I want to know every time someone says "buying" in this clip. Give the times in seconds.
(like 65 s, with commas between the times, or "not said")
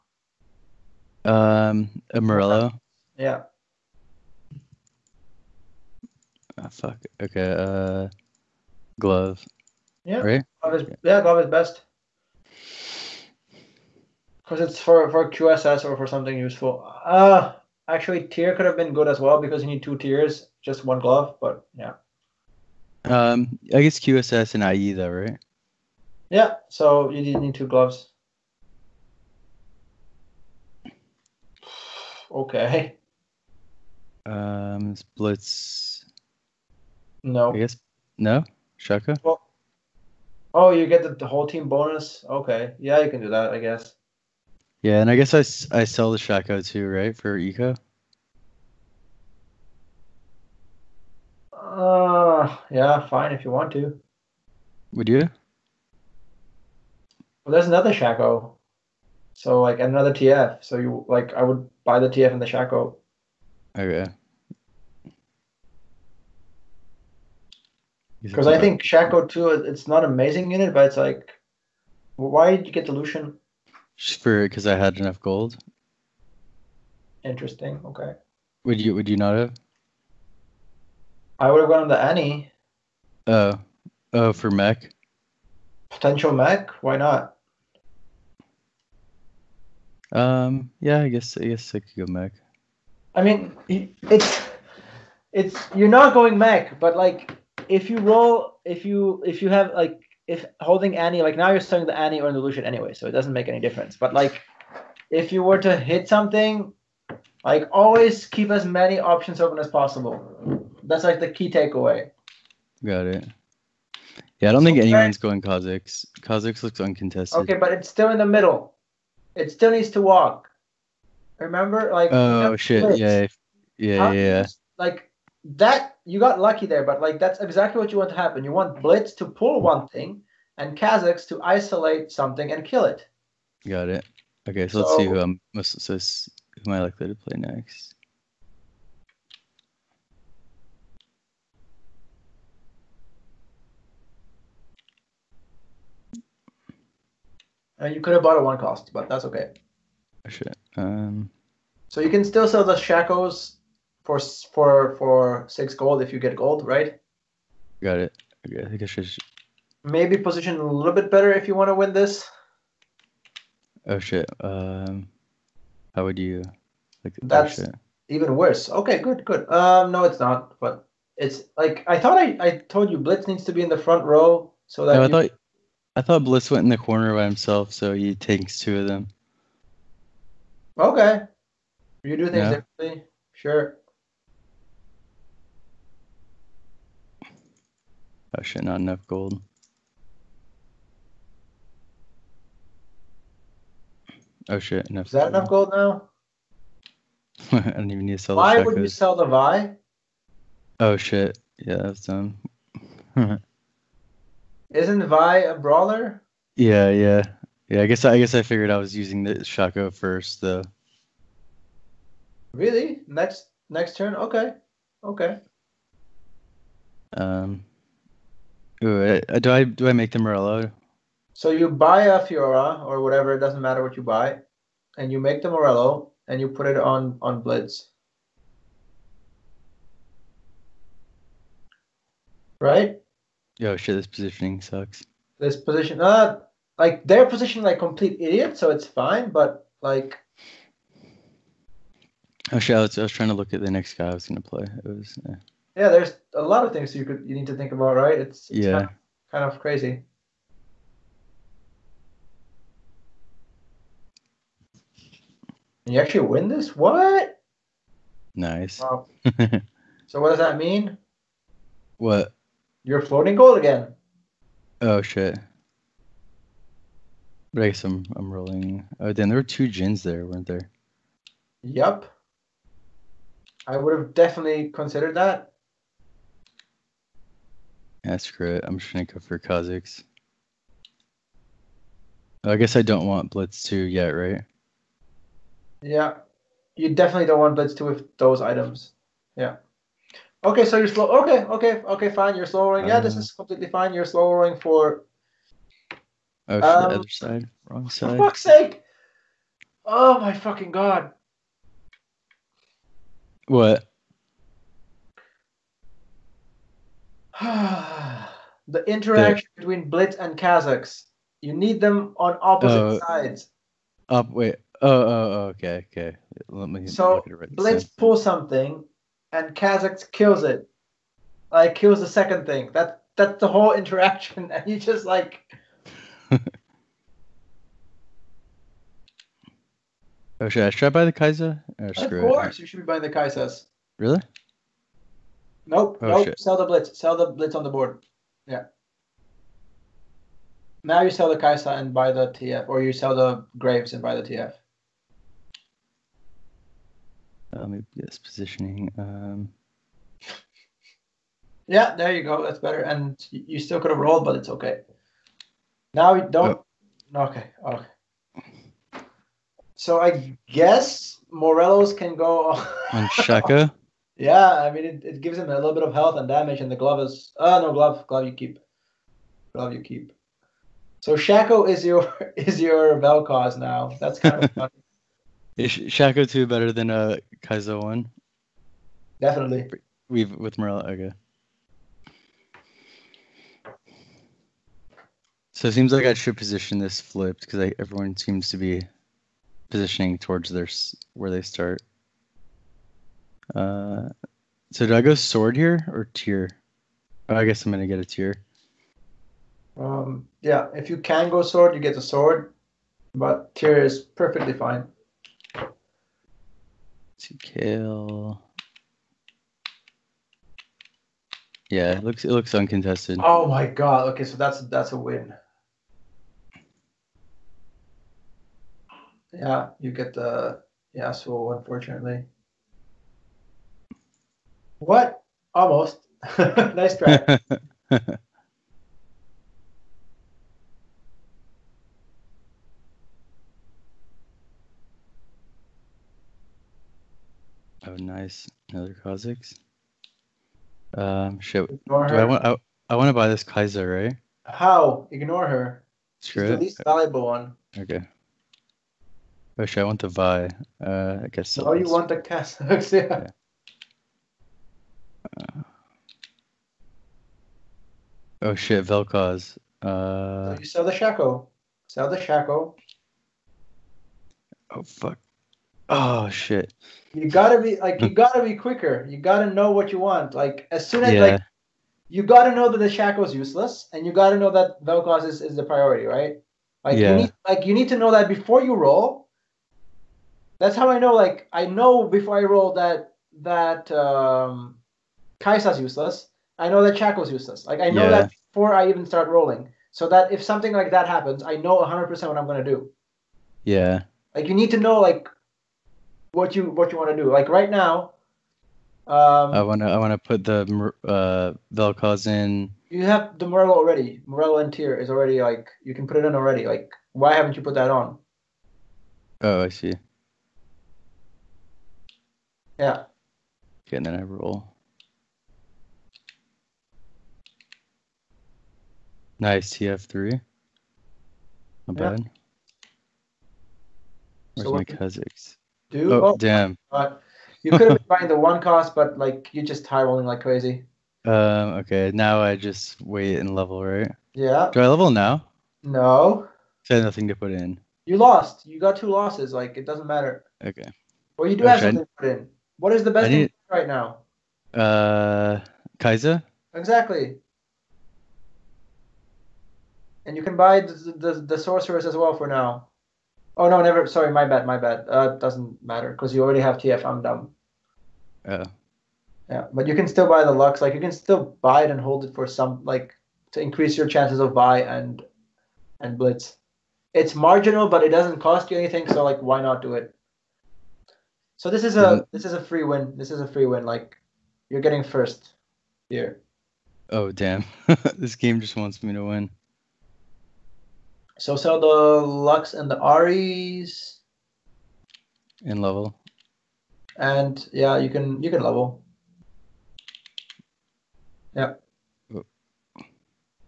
332 s, 528 s.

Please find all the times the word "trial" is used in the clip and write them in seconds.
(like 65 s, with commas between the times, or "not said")
not said.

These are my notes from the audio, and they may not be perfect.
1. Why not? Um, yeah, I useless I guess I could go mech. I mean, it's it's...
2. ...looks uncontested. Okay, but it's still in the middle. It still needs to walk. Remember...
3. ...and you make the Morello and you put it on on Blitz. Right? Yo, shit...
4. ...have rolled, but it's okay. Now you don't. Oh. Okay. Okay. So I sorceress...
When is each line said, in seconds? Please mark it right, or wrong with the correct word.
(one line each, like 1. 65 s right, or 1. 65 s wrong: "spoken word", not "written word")
1. 86 s wrong: "guess", not "useless"
2. 116 s right
3. 224 s right
4. 353 s wrong: "guess", not "sorceress".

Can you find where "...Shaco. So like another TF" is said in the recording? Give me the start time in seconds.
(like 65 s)
57 s.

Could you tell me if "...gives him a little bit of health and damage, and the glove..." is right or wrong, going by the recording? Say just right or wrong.
right.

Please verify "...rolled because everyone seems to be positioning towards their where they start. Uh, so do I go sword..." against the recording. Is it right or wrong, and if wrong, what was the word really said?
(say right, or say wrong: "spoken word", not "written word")
wrong: "flipped", not "rolled".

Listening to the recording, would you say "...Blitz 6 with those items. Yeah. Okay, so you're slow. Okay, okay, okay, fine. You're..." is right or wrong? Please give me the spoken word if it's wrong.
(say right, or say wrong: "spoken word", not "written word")
wrong: "2", not "6".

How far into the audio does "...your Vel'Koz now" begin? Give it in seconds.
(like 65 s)
372 s.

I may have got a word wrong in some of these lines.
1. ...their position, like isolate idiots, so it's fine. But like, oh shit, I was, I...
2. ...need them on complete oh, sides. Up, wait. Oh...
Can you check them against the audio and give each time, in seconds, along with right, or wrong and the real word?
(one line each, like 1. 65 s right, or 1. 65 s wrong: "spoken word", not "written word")
1. 237 s wrong: "complete", not "isolate"
2. 311 s wrong: "opposite", not "complete".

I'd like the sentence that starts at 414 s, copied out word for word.
Okay, so that's that's a win.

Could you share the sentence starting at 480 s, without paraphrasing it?
That's how I know like I know before I roll that that um Kaisa's useless.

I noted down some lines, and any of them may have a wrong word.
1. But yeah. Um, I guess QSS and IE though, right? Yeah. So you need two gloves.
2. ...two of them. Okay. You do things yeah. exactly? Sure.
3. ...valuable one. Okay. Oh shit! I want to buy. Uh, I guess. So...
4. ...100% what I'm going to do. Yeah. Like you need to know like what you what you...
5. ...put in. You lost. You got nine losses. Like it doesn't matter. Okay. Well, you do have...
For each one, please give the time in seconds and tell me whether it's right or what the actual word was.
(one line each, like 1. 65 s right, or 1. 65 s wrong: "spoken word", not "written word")
1. 21 s right
2. 178 s wrong: "differently", not "exactly"
3. 446 s right
4. 491 s right
5. 537 s wrong: "two", not "nine".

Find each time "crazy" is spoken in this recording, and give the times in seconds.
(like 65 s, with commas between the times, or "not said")
249 s, 530 s.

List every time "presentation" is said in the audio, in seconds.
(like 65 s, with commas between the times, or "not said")
not said.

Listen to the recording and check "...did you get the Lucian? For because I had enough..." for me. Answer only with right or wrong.
right.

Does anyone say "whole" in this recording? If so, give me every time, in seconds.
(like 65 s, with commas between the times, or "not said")
41 s, 323 s.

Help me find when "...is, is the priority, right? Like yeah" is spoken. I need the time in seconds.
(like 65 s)
475 s.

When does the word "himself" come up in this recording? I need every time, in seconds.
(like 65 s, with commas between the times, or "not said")
177 s.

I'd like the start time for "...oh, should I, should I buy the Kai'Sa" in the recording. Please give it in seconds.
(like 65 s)
330 s.